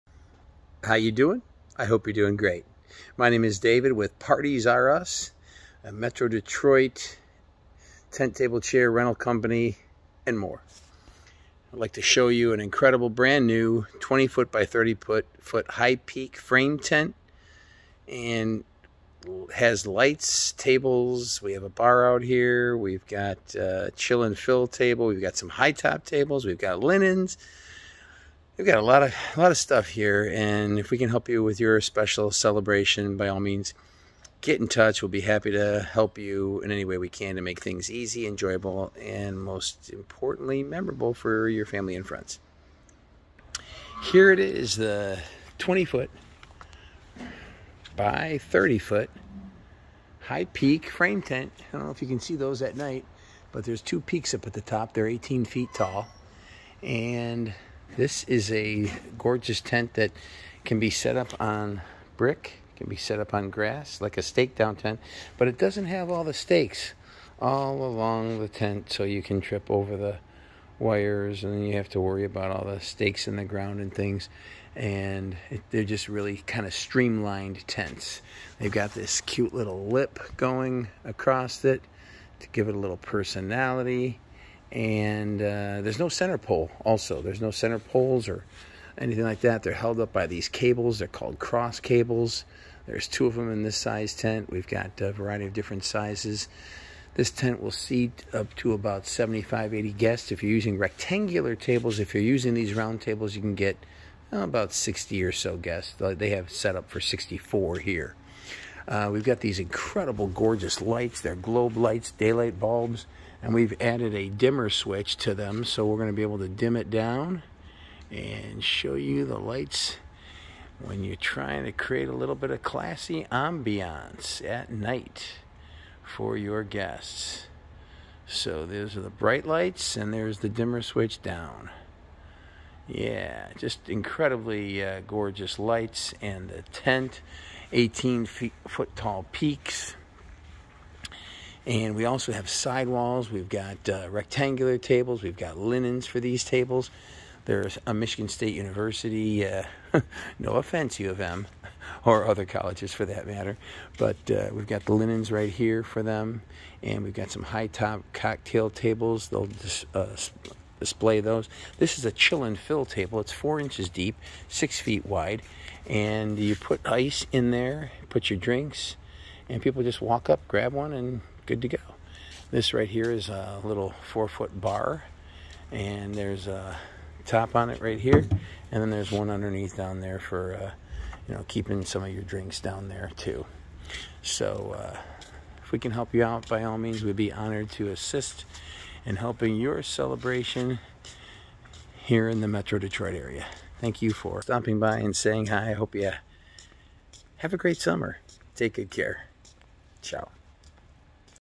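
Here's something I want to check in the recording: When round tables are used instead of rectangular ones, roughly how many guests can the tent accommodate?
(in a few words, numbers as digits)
60.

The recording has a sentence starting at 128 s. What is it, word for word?
So those are the bright lights and there's the dimmer switch down.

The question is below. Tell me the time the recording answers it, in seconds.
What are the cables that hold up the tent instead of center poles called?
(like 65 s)
91 s.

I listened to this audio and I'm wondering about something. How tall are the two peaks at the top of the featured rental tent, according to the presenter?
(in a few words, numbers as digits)
18 feet.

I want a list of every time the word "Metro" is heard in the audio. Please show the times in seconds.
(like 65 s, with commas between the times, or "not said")
5 s, 192 s.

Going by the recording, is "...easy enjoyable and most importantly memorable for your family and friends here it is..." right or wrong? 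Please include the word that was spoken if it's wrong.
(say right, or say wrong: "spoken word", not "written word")
right.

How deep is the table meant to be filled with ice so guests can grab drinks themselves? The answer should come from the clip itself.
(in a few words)
4 inches.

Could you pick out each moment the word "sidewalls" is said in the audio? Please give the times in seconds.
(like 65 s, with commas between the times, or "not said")
142 s.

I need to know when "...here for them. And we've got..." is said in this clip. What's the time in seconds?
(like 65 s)
155 s.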